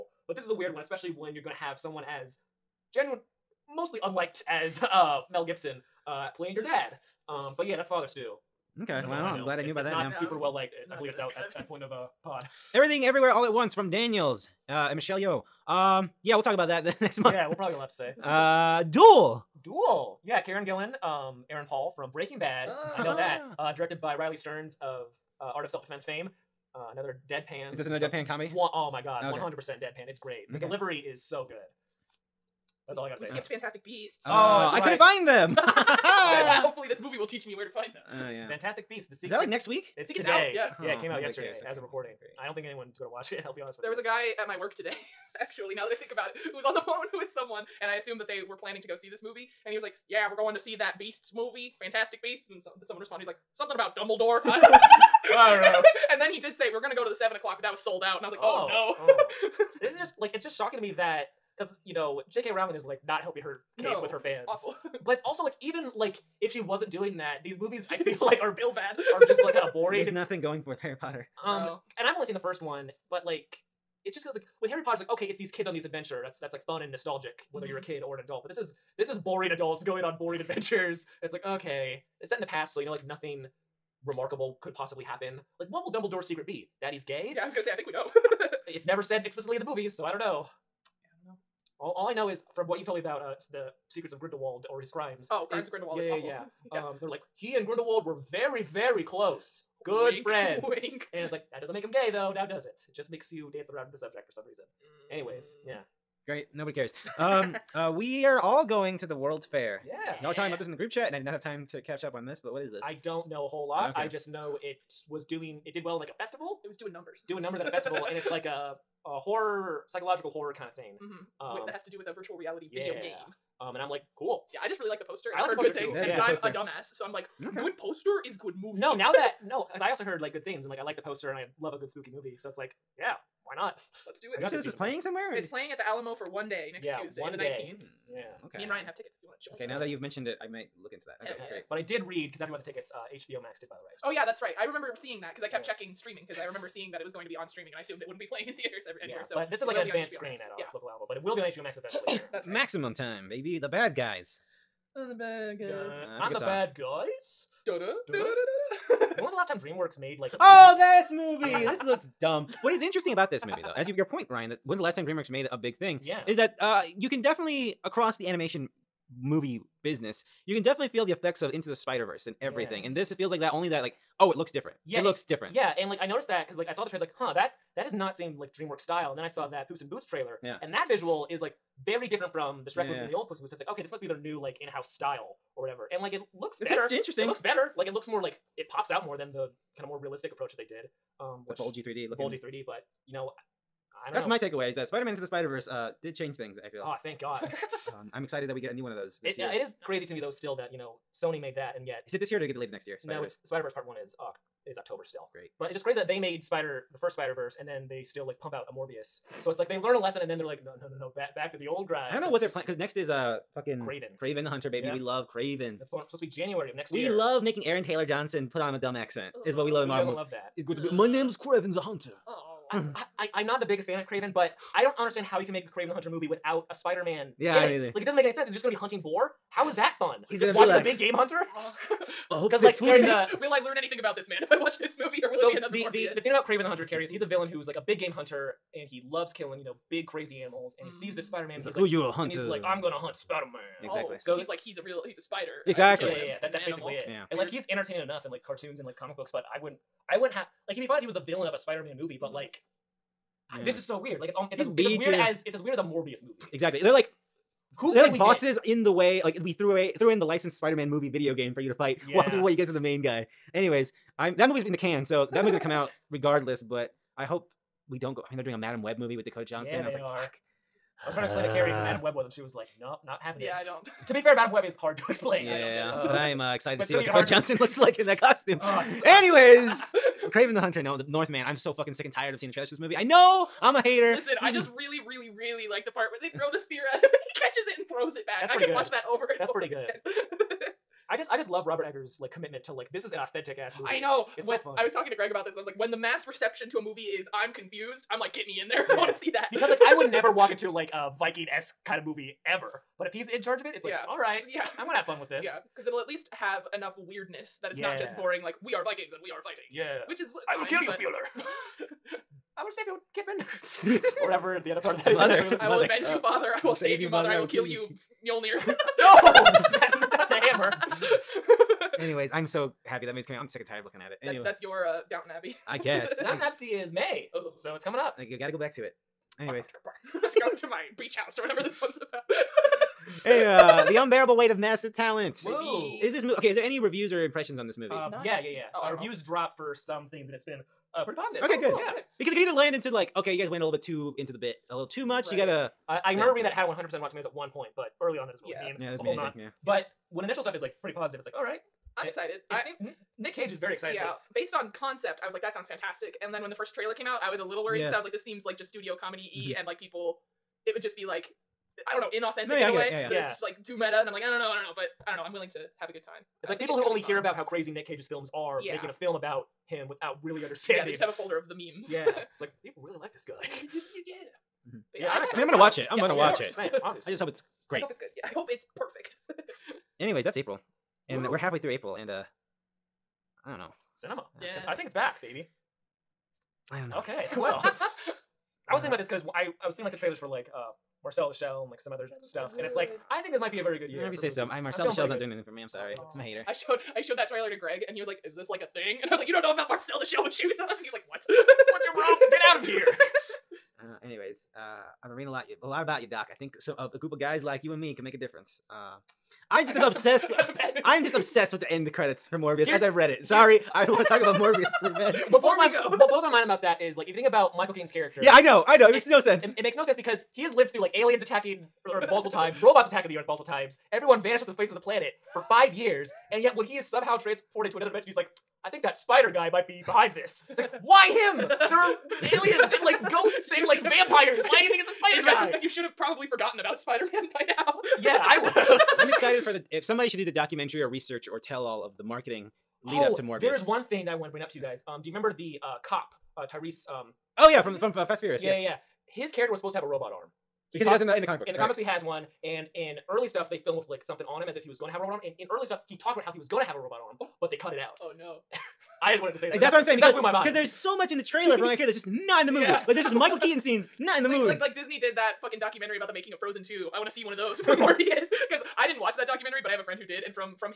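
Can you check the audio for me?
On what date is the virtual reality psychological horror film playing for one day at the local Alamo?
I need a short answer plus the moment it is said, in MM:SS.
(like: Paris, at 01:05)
the 19th, at 02:17.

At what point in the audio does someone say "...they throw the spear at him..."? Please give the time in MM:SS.
04:46.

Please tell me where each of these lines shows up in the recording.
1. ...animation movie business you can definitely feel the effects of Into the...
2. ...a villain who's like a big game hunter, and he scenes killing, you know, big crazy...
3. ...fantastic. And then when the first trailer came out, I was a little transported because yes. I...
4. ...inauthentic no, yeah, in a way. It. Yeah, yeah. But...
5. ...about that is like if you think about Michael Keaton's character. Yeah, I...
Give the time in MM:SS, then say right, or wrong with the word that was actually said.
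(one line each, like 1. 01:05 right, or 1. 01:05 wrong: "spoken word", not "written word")
1. 02:48 right
2. 03:57 wrong: "loves", not "scenes"
3. 05:55 wrong: "worried", not "transported"
4. 06:02 right
5. 06:56 right.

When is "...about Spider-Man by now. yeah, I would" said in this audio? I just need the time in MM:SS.
07:16.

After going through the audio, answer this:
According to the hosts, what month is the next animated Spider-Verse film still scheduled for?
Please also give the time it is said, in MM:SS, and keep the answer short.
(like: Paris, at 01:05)
October, at 03:24.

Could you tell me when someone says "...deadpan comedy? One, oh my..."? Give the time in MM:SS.
00:27.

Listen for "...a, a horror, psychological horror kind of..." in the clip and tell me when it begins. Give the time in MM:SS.
01:58.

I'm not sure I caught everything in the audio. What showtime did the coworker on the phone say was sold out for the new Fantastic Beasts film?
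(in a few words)
7 o'clock.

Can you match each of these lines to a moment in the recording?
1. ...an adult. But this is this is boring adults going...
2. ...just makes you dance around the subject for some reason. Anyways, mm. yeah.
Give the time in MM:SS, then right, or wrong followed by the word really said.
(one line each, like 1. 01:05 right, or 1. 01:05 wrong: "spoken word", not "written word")
1. 01:18 right
2. 01:42 right.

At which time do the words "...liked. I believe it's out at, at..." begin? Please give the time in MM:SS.
00:10.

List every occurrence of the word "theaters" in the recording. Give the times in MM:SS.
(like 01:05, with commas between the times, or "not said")
02:28.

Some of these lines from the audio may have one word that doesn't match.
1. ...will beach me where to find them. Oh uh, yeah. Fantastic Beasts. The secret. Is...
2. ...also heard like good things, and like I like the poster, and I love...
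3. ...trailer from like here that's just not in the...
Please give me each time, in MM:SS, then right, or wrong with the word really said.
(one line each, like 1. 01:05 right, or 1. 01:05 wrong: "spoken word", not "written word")
1. 00:37 wrong: "teach", not "beach"
2. 02:09 right
3. 07:41 right.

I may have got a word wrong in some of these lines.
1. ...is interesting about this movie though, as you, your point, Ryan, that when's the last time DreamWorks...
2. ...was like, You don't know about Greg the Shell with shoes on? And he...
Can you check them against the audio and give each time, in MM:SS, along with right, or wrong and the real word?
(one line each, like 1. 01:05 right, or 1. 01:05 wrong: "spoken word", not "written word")
1. 02:42 right
2. 06:39 wrong: "Marcel", not "Greg".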